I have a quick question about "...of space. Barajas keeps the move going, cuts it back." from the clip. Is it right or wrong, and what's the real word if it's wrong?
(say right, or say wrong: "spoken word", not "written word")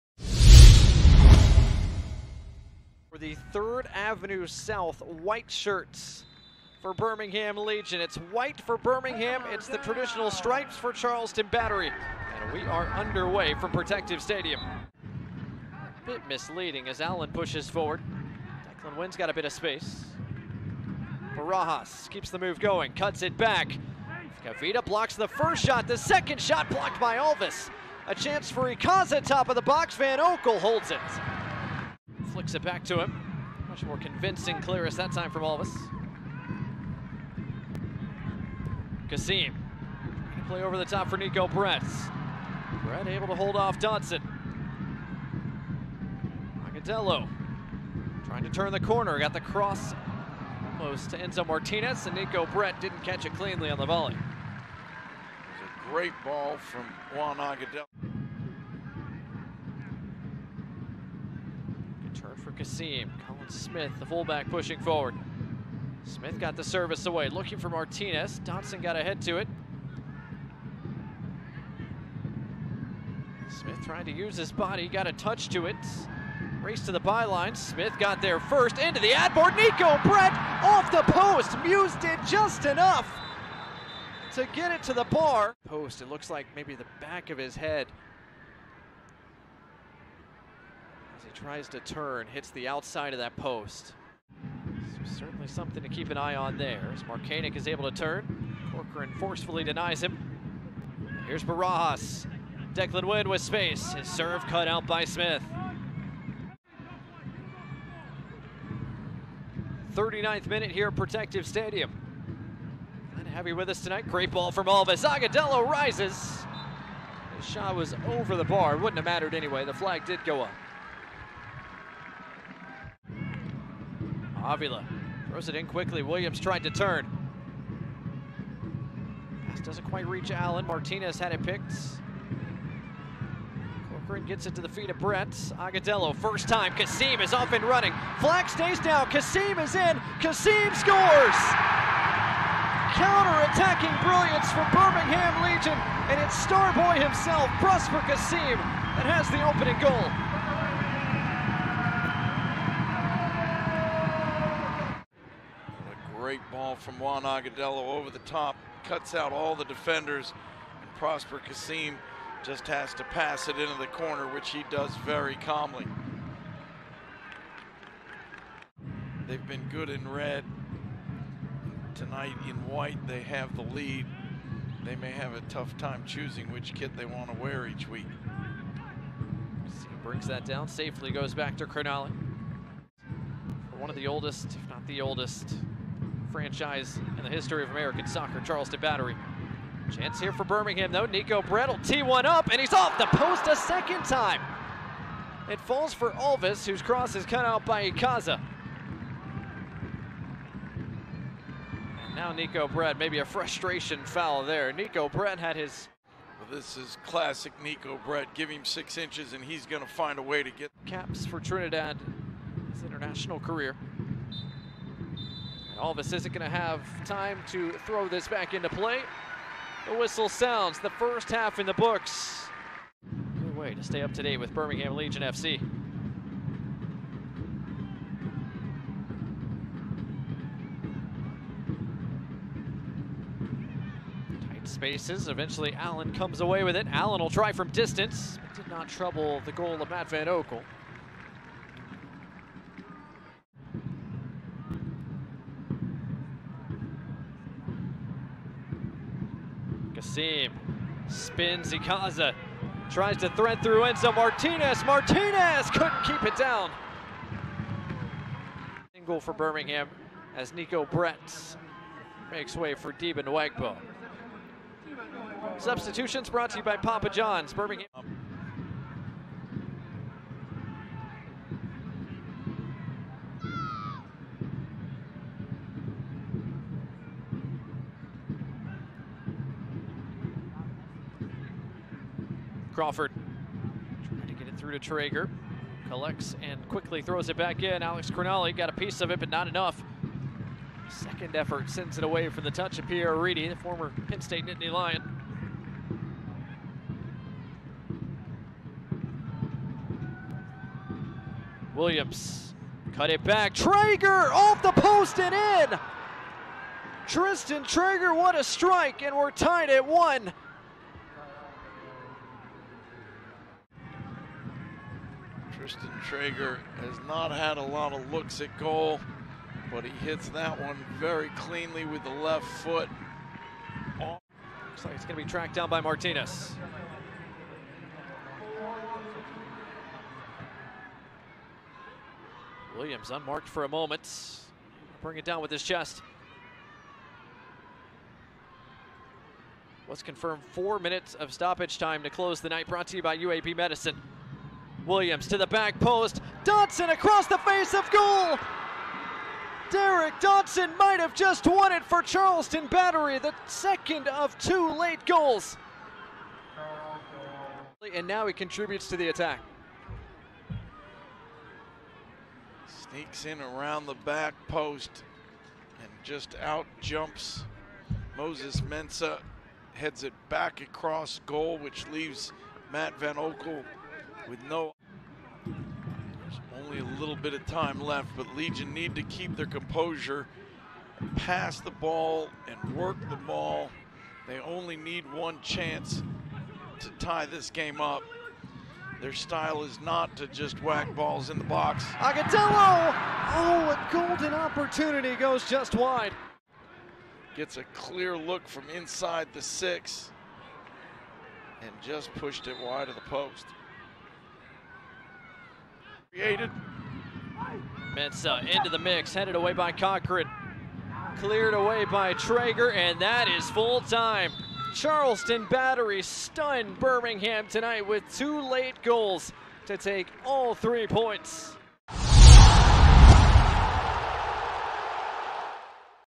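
right.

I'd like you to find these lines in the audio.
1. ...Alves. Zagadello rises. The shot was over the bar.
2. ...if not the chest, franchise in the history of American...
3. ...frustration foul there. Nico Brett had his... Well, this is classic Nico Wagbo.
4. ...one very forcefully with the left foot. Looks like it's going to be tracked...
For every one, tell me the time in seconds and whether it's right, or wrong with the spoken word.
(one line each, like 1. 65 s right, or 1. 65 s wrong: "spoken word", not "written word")
1. 114 s right
2. 184 s wrong: "oldest", not "chest"
3. 203 s wrong: "Brett", not "Wagbo"
4. 320 s wrong: "cleanly", not "forcefully".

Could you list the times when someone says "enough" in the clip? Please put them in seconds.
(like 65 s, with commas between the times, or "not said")
82 s, 289 s.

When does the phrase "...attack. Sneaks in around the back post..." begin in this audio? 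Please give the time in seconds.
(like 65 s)
359 s.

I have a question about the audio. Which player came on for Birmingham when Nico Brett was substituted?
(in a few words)
Deben Wagbo.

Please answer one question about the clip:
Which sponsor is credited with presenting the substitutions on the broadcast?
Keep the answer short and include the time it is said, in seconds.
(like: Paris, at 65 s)
Papa John's, at 266 s.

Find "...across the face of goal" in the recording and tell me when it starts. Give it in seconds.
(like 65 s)
346 s.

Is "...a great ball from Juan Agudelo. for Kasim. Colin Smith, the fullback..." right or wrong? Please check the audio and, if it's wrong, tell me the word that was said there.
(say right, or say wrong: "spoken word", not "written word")
right.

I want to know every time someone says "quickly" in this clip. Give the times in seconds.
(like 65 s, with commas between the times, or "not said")
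125 s, 286 s.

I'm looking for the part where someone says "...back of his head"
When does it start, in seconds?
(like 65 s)
86 s.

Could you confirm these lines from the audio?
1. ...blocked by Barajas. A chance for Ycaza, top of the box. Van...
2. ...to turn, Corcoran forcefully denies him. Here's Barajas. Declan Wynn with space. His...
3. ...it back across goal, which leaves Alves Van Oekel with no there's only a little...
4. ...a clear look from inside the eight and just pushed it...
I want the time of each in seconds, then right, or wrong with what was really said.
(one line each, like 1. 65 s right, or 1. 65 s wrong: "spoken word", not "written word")
1. 26 s wrong: "Alvis", not "Barajas"
2. 97 s right
3. 370 s wrong: "Matt", not "Alves"
4. 397 s wrong: "six", not "eight".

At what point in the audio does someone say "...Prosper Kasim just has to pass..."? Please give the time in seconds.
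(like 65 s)
160 s.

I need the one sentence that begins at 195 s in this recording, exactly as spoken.
It falls for Alvis, whose cross is cut out by Ycaza.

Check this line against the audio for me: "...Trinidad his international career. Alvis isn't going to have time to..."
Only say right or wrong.
right.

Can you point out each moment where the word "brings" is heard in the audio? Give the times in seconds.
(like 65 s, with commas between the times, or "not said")
180 s, 335 s.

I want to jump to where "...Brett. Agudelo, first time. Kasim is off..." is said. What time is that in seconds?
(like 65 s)
134 s.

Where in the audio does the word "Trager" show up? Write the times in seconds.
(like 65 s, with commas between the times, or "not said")
284 s, 303 s, 307 s, 316 s, 412 s.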